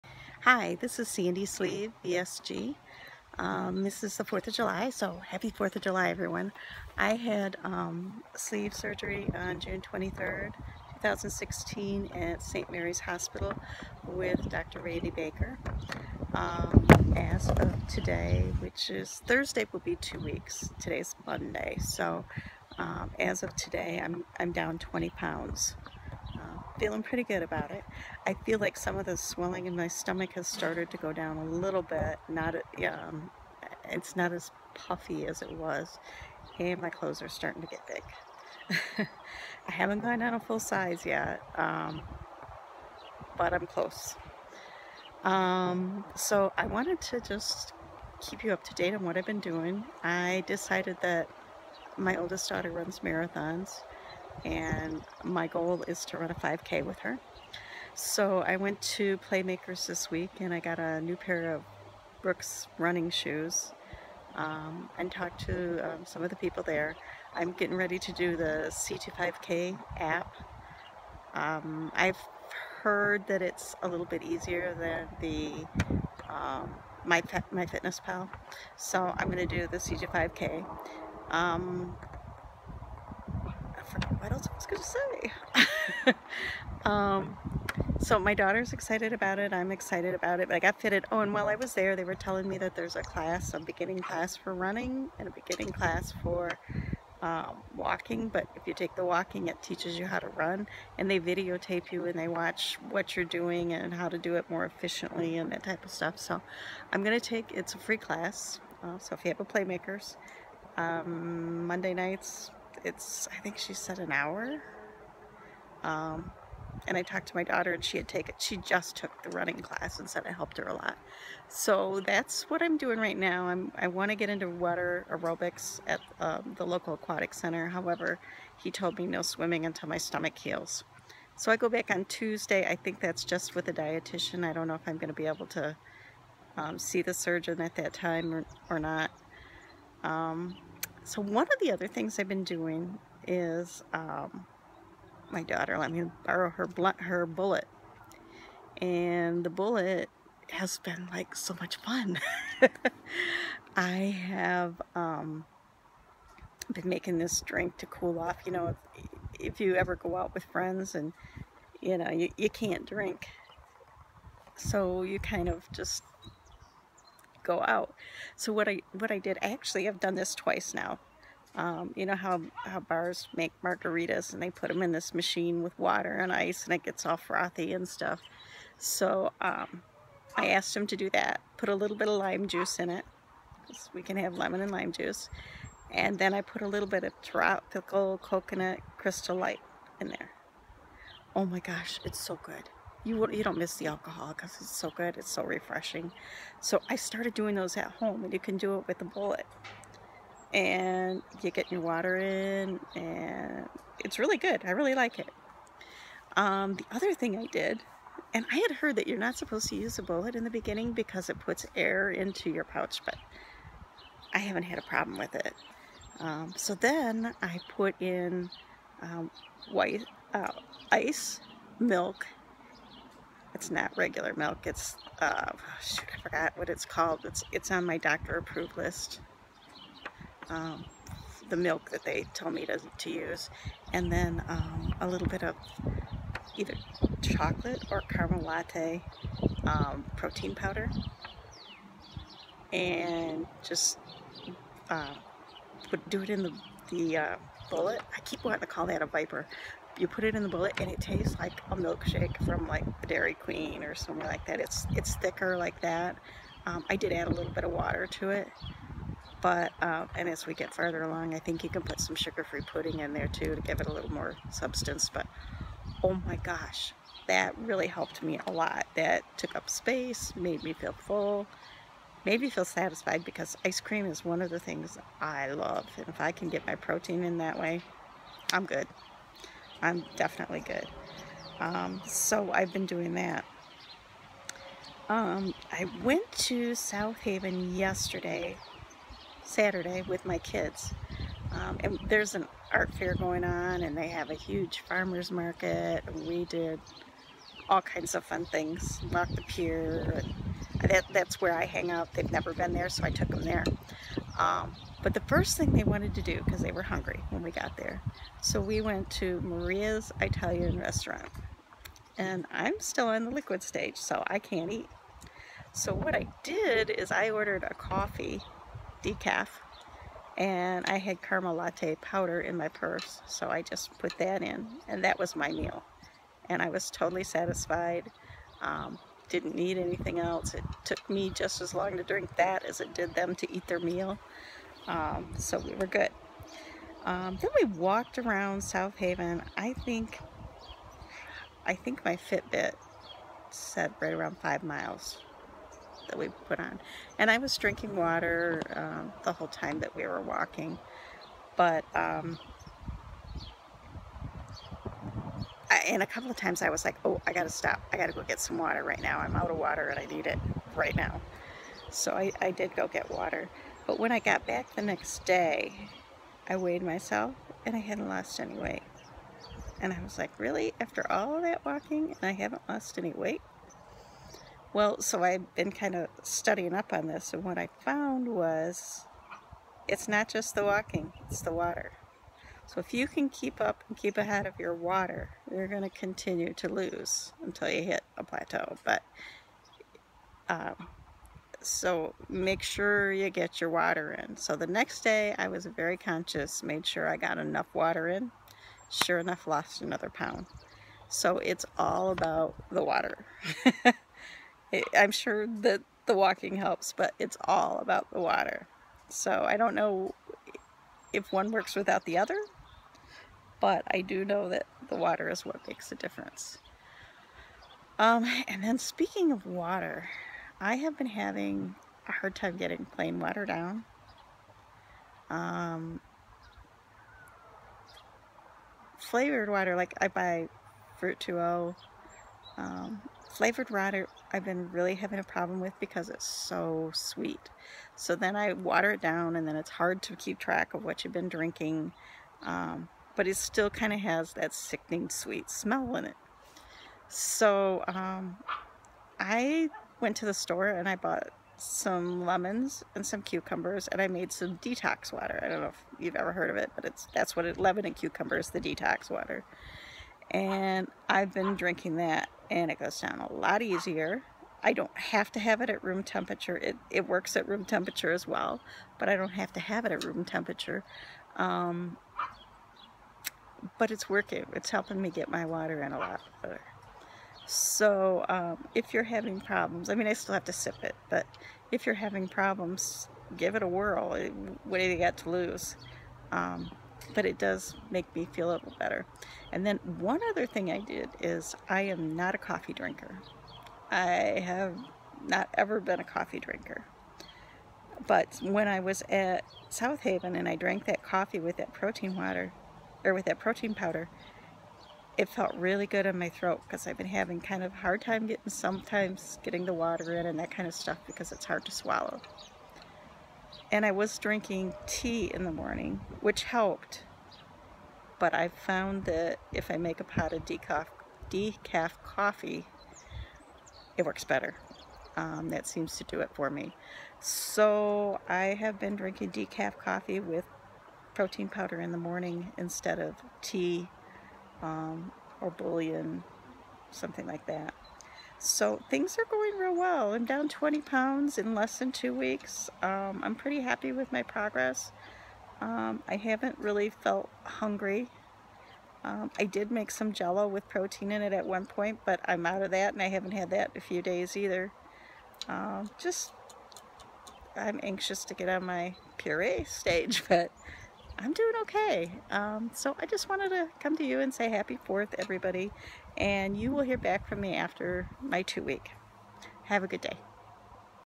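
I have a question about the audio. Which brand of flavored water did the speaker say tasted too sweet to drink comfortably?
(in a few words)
Fruit 2O.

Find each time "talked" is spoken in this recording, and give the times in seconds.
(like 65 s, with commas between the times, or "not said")
65 s, 117 s.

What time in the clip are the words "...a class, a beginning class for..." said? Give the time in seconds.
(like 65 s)
92 s.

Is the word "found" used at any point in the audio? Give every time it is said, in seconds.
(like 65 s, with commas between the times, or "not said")
377 s, 518 s.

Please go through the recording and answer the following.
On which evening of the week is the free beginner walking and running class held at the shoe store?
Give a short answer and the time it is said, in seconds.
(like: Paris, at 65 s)
Monday nights, at 111 s.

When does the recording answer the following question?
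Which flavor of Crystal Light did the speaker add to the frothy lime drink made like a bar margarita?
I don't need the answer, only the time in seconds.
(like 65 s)
187 s.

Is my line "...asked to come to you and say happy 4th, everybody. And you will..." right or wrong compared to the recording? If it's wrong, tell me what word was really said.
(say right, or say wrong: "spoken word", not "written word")
wrong: "wanted", not "asked".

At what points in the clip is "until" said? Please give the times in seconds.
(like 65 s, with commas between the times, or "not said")
129 s, 387 s.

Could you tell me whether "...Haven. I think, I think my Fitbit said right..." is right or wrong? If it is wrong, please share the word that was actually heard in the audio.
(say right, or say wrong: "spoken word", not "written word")
right.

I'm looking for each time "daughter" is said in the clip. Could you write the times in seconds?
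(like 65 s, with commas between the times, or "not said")
52 s, 88 s, 117 s, 145 s.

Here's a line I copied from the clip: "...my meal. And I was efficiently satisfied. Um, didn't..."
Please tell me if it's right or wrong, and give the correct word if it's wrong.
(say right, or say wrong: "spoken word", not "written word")
wrong: "totally", not "efficiently".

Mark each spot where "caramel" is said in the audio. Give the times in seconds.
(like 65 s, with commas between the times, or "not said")
238 s, 321 s.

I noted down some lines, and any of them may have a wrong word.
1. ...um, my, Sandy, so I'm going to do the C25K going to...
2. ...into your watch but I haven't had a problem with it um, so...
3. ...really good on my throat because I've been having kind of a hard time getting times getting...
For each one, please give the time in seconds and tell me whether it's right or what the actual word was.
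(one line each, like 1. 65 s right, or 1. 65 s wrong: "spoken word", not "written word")
1. 76 s wrong: "MyFitnessPal", not "Sandy"
2. 212 s wrong: "pouch", not "watch"
3. 505 s wrong: "sometimes", not "times".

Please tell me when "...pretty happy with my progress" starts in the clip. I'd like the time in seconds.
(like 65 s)
543 s.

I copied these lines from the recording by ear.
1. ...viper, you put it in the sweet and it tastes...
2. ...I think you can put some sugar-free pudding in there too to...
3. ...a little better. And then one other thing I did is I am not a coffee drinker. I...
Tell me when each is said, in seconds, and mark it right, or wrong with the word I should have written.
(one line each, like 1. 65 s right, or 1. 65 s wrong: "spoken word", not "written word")
1. 249 s wrong: "bullet", not "sweet"
2. 261 s right
3. 488 s right.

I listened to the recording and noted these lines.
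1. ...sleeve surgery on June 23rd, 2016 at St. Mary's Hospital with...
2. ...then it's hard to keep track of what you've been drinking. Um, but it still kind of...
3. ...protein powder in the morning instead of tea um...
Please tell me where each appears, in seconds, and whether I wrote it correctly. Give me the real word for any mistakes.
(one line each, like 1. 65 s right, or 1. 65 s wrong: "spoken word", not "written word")
1. 8 s right
2. 439 s right
3. 531 s right.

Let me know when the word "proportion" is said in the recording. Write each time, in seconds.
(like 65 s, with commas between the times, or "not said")
not said.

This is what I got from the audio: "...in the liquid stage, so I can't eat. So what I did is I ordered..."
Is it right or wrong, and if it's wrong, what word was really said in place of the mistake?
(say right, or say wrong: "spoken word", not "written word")
right.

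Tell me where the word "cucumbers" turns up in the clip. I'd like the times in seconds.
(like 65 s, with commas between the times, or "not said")
453 s, 457 s.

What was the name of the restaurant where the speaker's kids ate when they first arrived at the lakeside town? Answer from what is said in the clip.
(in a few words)
Maria's Italian restaurant.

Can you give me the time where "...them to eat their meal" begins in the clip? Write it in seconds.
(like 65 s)
333 s.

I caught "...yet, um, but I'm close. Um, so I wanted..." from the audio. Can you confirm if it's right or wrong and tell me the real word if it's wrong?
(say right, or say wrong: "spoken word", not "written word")
right.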